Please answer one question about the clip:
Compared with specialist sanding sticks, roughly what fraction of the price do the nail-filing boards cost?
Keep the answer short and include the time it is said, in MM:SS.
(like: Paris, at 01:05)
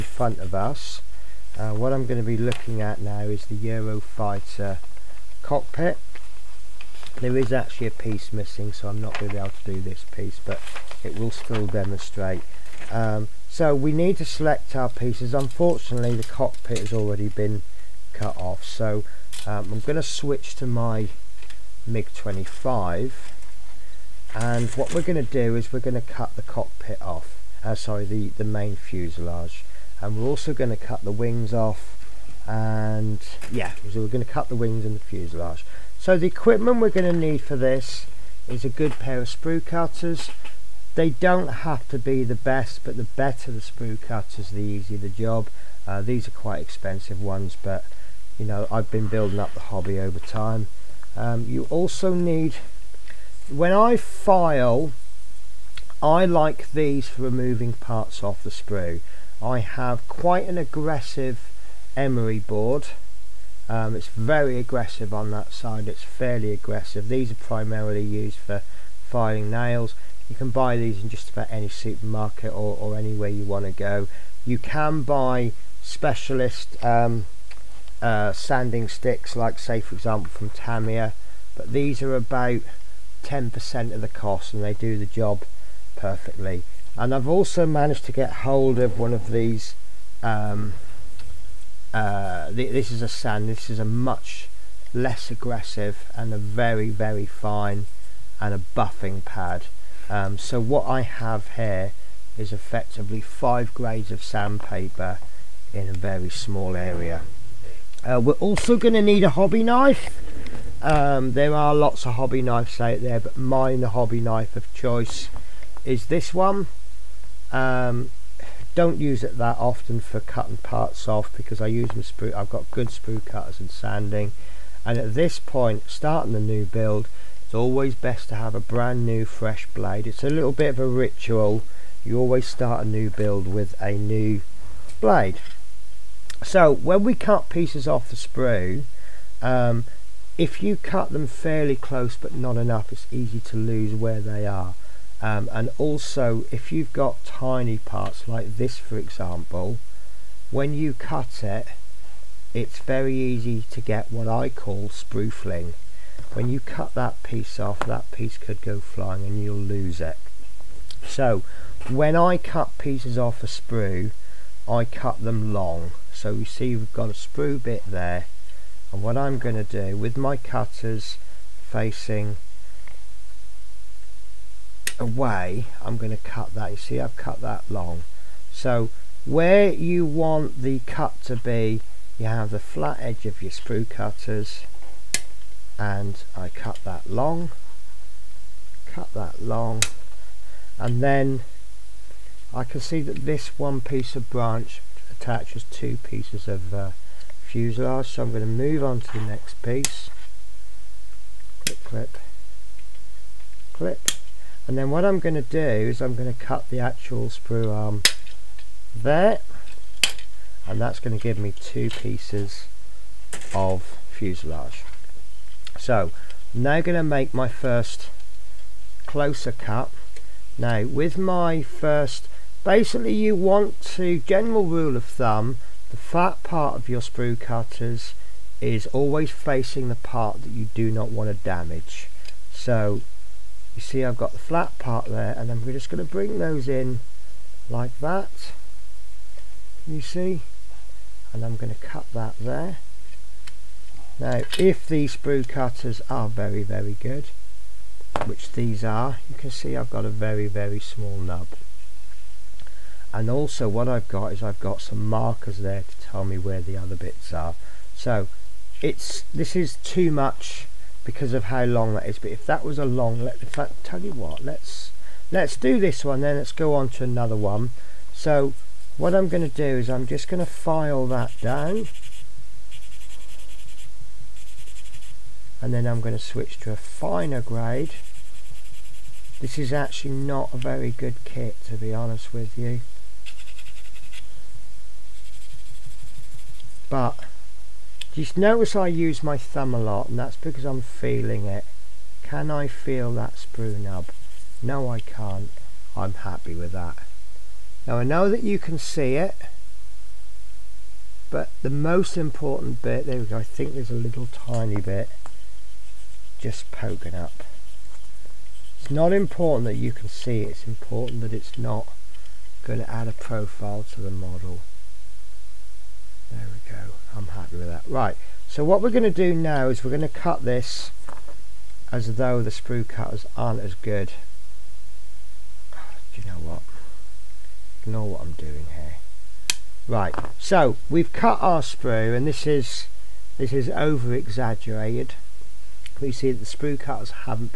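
10%, at 01:23.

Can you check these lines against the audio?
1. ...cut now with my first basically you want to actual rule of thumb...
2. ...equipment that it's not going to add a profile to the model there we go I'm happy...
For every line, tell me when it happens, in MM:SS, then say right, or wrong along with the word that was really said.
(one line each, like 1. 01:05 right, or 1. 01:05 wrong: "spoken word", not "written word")
1. 03:39 wrong: "general", not "actual"
2. 05:10 wrong: "important", not "equipment".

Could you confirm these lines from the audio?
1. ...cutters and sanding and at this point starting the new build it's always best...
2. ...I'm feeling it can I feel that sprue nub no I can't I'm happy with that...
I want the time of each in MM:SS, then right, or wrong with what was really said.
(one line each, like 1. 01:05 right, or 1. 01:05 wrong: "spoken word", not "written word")
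1. 02:03 right
2. 04:50 right.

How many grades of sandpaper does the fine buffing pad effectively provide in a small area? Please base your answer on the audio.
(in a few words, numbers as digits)
5.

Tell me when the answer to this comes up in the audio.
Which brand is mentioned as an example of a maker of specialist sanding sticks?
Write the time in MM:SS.
01:20.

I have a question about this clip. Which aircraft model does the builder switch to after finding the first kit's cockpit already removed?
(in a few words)
MiG-25.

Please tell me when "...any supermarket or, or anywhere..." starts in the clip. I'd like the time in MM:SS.
01:11.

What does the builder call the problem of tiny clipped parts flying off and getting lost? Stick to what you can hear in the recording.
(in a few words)
sprufling.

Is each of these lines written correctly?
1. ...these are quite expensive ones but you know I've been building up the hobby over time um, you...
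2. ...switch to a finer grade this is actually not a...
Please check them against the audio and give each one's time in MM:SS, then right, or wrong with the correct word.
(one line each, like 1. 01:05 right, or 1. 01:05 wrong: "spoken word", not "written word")
1. 00:46 right
2. 04:36 right.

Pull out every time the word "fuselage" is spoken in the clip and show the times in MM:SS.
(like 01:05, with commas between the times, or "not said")
00:28, 00:34, 03:17, 03:34.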